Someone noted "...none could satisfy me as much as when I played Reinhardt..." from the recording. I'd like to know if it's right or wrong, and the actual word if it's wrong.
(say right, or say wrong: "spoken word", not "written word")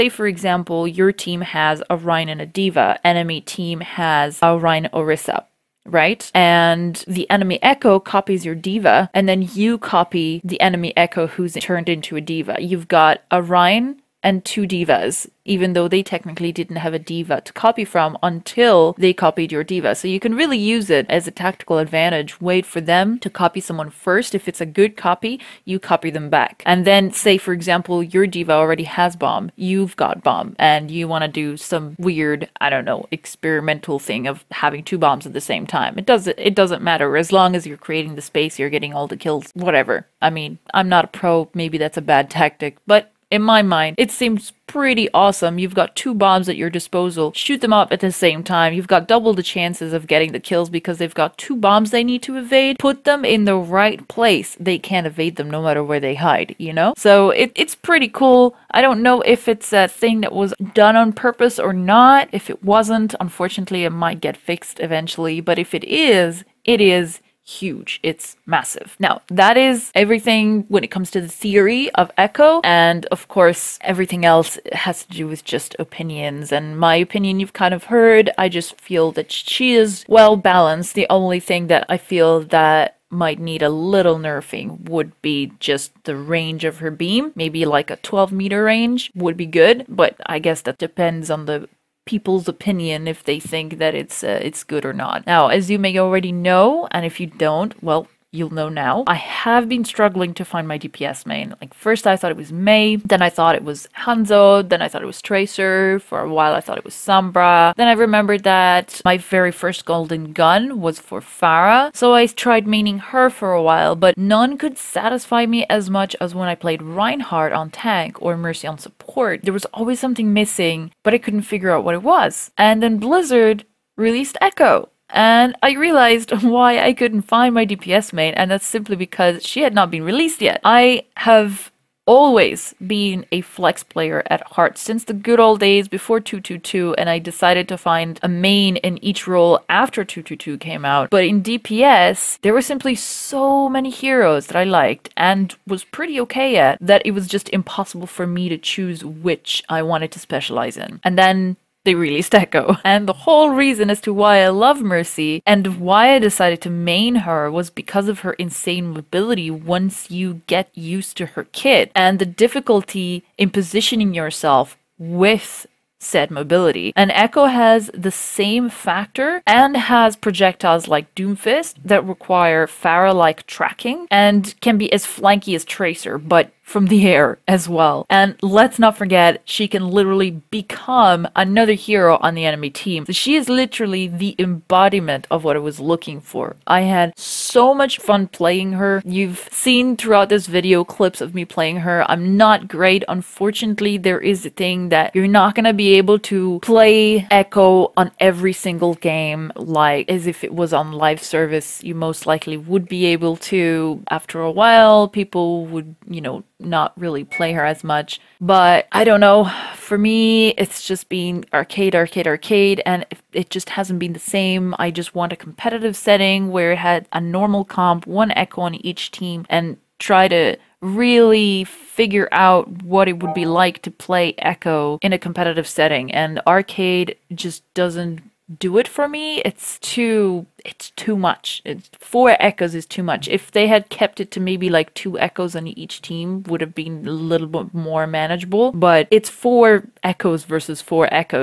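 right.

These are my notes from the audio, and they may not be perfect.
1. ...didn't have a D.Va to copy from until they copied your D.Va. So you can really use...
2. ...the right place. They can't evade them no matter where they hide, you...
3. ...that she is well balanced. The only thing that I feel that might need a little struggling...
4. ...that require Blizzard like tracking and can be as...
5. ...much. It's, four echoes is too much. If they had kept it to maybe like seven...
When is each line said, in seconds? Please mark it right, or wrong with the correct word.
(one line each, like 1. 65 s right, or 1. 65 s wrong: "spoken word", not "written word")
1. 16 s right
2. 53 s right
3. 79 s wrong: "nerfing", not "struggling"
4. 171 s wrong: "Pharah", not "Blizzard"
5. 231 s wrong: "two", not "seven".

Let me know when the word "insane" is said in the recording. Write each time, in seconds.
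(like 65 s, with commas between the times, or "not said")
158 s.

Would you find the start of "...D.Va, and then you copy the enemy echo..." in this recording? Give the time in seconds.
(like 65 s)
8 s.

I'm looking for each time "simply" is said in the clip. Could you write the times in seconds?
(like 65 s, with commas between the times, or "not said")
128 s, 142 s.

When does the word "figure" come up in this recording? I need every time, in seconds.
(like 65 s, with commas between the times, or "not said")
121 s, 221 s.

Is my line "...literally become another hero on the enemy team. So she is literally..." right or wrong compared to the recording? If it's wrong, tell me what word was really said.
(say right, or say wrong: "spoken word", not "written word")
right.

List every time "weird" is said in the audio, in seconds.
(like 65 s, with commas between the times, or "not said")
31 s.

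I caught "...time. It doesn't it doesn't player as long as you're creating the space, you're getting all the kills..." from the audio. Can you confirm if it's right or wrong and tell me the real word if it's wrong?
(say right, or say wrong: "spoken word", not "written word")
wrong: "matter", not "player".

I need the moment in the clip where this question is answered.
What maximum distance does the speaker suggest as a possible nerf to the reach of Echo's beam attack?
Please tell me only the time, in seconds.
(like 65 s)
87 s.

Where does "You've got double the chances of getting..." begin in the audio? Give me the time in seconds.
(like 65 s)
48 s.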